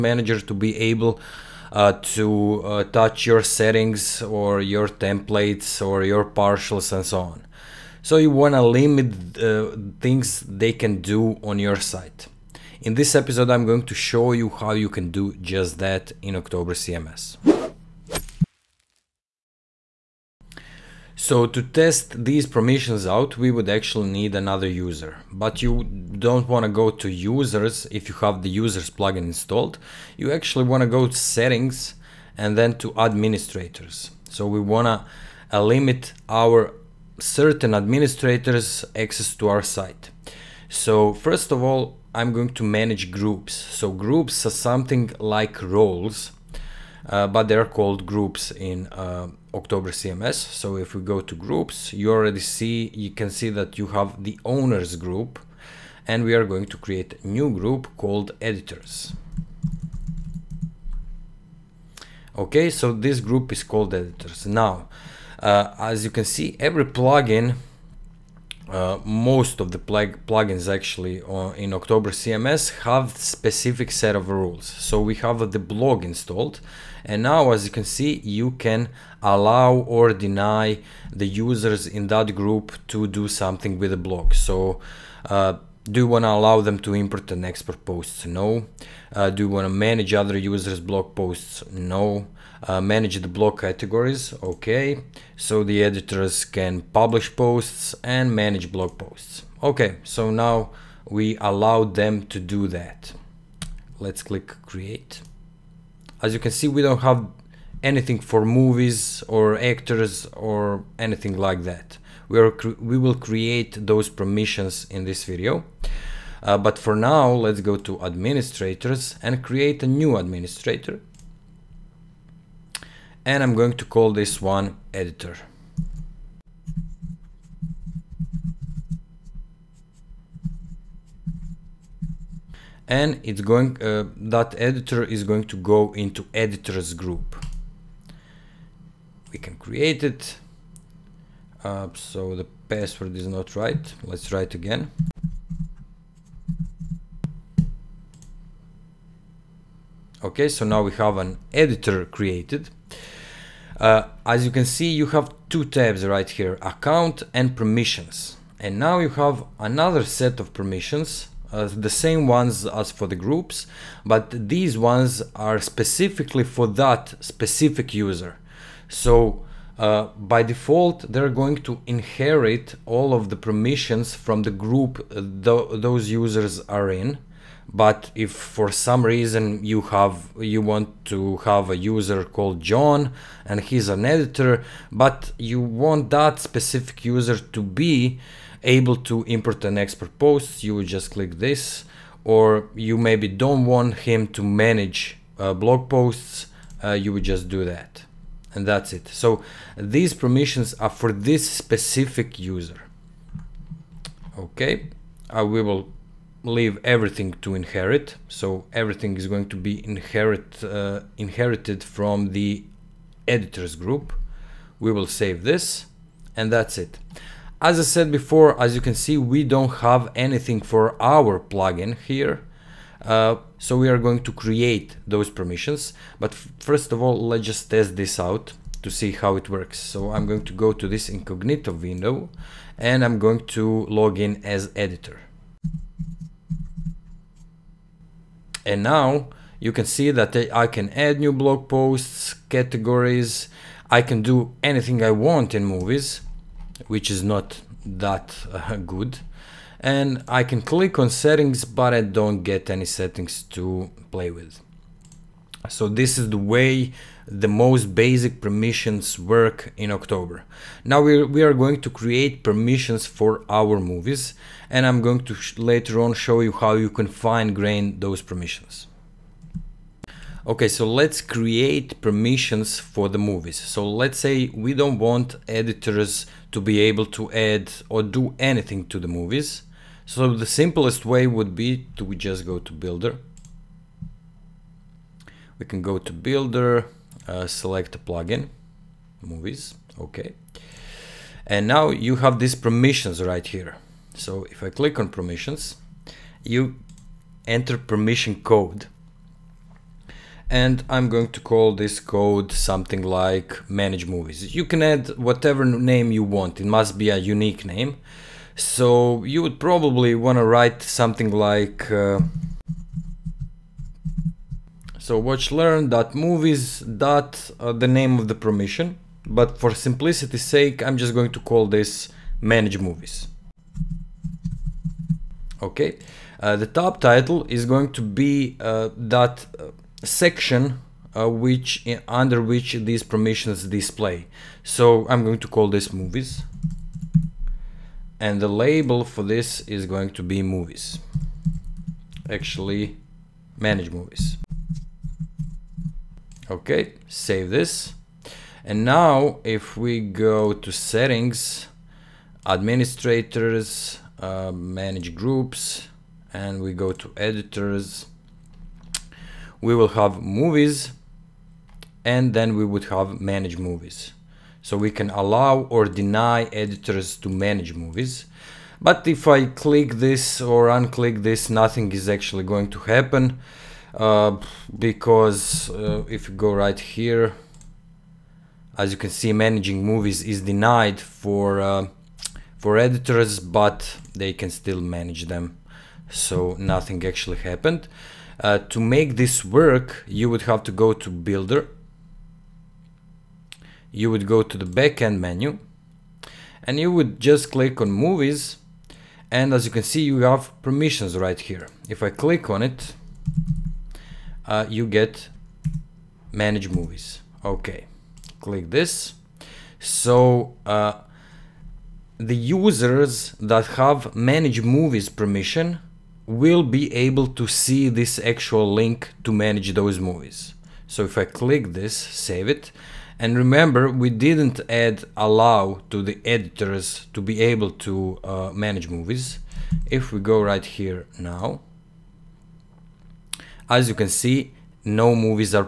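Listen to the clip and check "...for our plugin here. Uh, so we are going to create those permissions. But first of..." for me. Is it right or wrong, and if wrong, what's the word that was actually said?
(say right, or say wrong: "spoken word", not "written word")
right.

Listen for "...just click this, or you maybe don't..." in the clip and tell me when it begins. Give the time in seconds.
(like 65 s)
190 s.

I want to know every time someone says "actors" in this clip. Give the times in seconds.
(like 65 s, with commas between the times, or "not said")
109 s.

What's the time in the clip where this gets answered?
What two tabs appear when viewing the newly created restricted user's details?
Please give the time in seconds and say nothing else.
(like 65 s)
156 s.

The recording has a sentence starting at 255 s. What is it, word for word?
So this is the way the most basic permissions work in October.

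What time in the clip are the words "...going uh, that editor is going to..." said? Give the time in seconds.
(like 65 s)
133 s.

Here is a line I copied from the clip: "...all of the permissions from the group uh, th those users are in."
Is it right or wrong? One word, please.
right.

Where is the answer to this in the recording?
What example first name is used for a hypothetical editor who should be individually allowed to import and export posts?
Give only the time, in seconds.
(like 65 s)
182 s.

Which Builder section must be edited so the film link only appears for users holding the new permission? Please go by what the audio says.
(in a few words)
backend menu.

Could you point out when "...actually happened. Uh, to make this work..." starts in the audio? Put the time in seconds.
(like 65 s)
387 s.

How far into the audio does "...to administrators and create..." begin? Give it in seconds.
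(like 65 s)
117 s.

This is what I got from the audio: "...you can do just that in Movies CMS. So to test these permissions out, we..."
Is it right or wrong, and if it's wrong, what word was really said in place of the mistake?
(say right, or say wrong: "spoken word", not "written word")
wrong: "October", not "Movies".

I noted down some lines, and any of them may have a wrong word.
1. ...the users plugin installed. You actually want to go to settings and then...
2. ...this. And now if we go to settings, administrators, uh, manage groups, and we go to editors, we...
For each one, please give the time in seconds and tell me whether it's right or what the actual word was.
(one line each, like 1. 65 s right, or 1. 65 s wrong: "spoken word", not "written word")
1. 28 s right
2. 347 s right.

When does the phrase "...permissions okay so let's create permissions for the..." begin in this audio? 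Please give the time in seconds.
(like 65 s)
268 s.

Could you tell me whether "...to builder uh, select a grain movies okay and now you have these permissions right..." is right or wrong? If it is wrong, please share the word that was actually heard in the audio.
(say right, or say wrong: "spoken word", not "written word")
wrong: "plugin", not "grain".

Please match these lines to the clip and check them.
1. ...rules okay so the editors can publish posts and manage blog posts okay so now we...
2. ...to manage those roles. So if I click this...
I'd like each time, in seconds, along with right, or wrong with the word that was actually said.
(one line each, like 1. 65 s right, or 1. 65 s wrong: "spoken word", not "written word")
1. 93 s wrong: "categories", not "rules"
2. 419 s wrong: "movies", not "roles".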